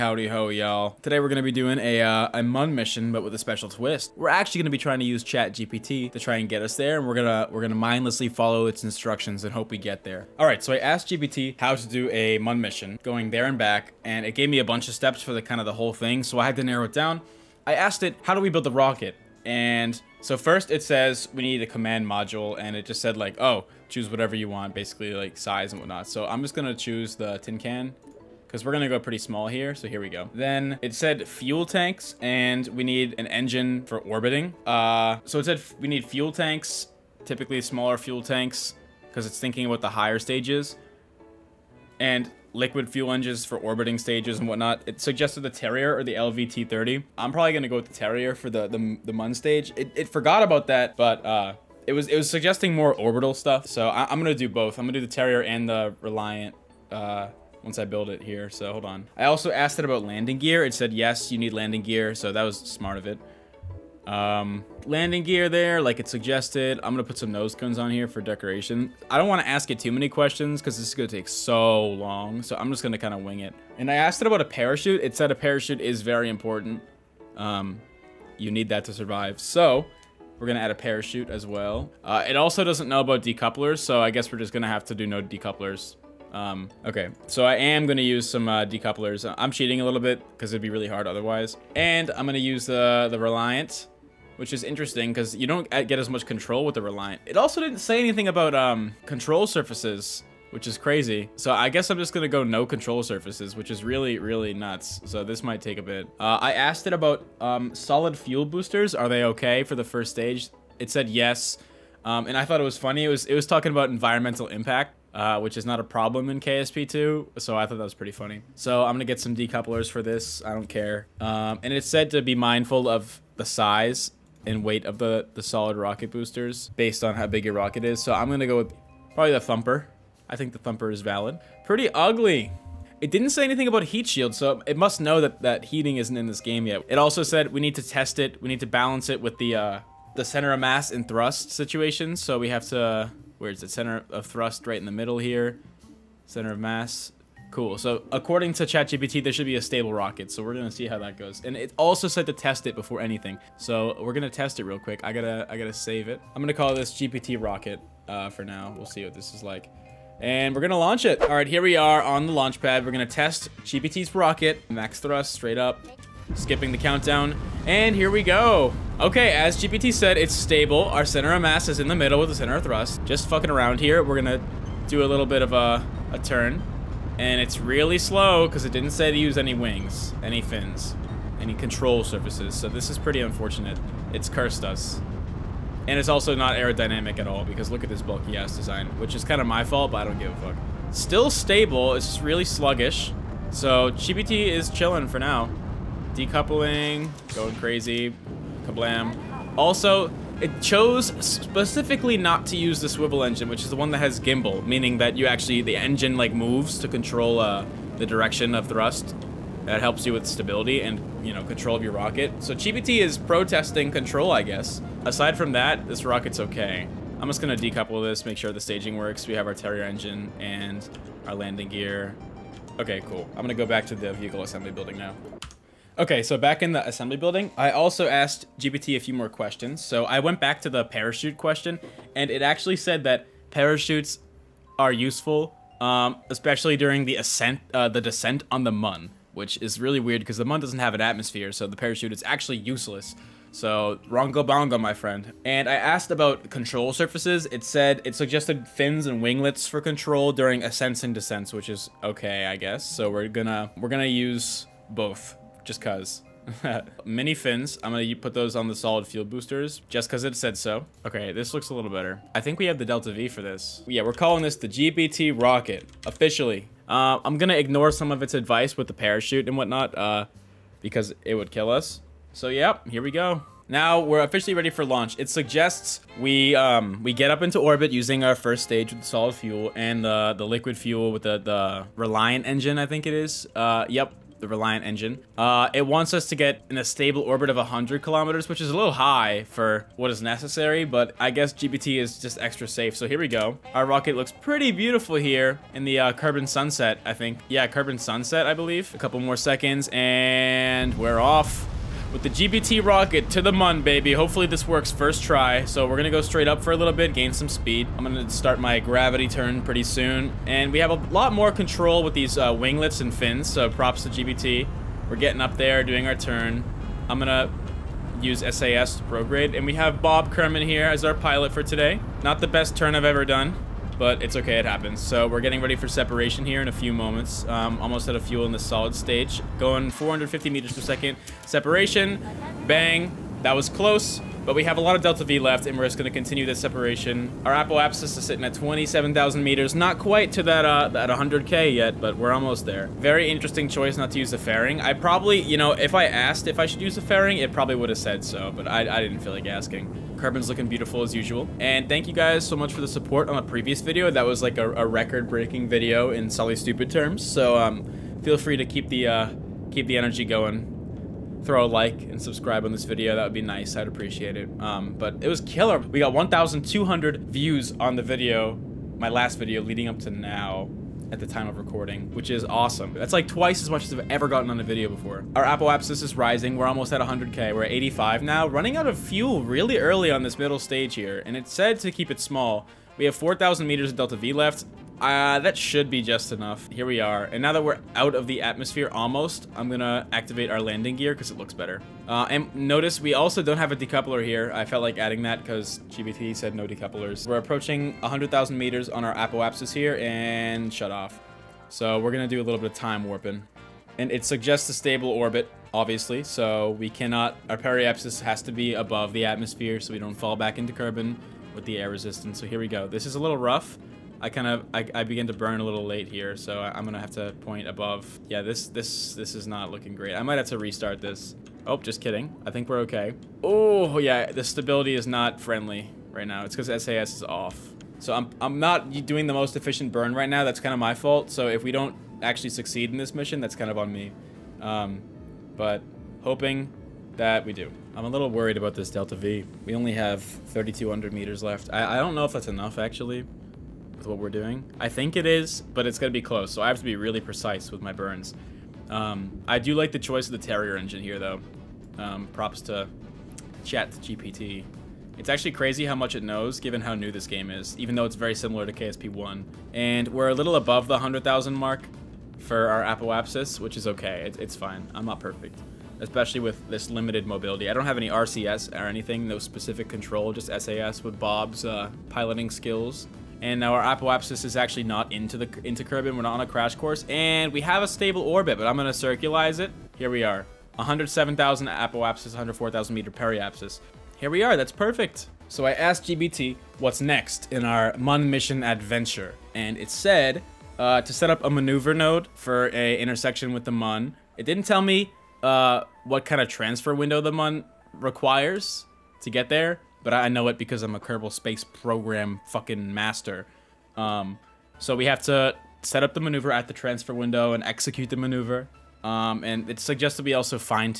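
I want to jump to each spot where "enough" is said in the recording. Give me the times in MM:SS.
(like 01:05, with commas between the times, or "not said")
06:26, 07:22.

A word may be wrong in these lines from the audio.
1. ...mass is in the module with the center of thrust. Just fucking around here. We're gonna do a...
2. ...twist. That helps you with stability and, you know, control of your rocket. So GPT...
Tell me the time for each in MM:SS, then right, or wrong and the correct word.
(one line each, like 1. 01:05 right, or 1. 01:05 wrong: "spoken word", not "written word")
1. 02:51 wrong: "middle", not "module"
2. 03:28 wrong: "thrust", not "twist".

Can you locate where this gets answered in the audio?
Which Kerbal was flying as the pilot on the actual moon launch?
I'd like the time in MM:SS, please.
05:20.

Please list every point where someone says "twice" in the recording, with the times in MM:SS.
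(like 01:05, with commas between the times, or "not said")
06:13.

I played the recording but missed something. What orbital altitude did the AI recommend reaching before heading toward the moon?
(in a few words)
100 kilometers.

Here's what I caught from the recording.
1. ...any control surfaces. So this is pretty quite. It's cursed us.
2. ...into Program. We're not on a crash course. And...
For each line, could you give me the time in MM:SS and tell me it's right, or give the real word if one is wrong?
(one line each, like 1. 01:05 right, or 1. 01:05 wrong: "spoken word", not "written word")
1. 03:01 wrong: "unfortunate", not "quite"
2. 07:55 wrong: "Kerbin", not "Program".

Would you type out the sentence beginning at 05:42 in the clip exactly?
Very interesting choice not to use the fairing.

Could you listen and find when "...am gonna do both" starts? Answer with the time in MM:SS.
00:54.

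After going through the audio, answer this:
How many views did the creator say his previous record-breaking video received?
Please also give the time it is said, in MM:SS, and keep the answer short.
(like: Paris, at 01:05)
1,200, at 06:06.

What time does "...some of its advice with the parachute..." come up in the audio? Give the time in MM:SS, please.
04:27.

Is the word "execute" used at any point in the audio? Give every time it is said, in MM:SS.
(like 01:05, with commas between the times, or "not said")
08:27.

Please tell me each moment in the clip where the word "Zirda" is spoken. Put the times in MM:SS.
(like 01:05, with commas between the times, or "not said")
not said.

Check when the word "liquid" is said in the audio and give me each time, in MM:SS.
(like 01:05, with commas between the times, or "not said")
00:42, 04:40.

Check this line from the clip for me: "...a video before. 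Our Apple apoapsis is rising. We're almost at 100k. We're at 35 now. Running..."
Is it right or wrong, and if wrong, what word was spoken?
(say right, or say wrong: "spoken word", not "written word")
wrong: "85", not "35".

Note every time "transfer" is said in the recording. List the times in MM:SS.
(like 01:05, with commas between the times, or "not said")
08:16, 08:26.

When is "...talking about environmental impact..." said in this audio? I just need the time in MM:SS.
01:53.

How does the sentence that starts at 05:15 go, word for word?
We're getting up there, doing our turn.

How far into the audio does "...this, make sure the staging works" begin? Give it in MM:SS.
03:38.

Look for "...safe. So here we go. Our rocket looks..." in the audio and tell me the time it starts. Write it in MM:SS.
04:52.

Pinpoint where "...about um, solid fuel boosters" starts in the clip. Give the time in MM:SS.
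01:46.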